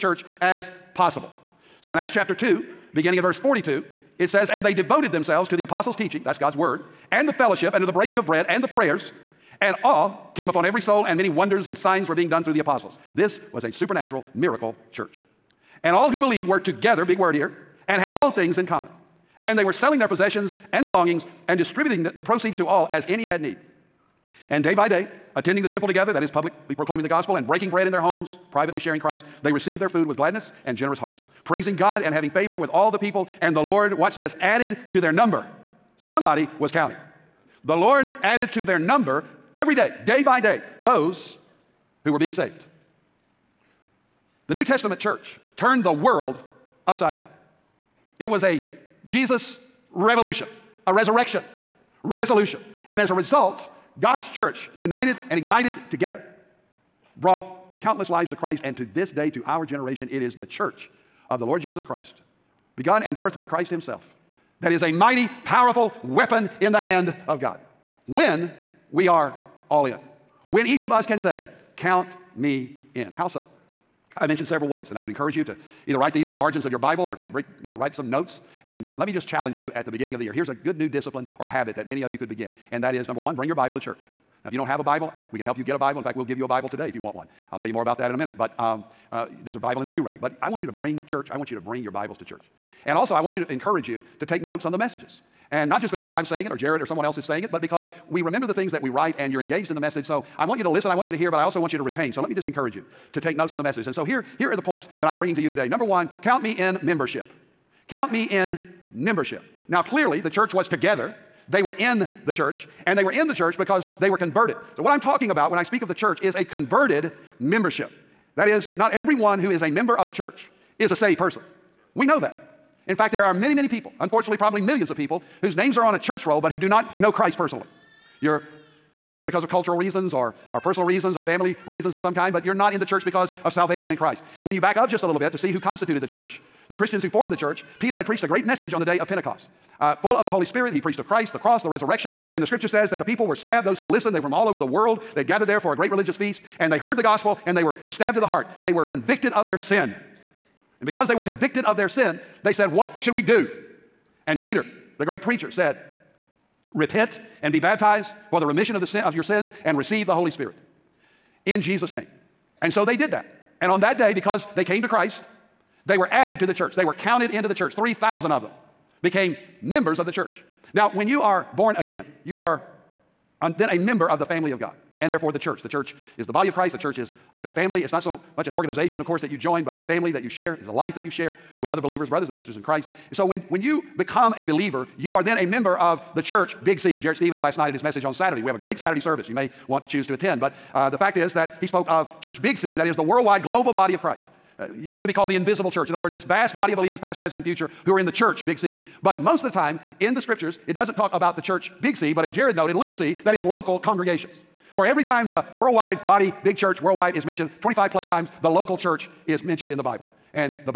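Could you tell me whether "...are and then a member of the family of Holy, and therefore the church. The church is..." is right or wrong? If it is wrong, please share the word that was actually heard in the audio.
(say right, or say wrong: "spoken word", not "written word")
wrong: "God", not "Holy".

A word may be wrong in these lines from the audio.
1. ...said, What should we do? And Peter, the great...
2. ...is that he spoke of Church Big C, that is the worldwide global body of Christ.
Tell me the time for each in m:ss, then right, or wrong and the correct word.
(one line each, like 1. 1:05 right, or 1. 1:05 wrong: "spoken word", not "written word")
1. 2:32 right
2. 3:11 right.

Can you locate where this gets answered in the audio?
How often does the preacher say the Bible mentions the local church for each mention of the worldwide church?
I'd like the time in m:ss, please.
3:27.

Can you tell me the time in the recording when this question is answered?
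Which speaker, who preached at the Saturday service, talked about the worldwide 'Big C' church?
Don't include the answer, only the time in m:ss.
3:06.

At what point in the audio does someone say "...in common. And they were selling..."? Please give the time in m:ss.
0:18.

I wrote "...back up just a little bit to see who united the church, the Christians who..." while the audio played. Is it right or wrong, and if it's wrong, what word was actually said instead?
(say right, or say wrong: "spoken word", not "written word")
wrong: "constituted", not "united".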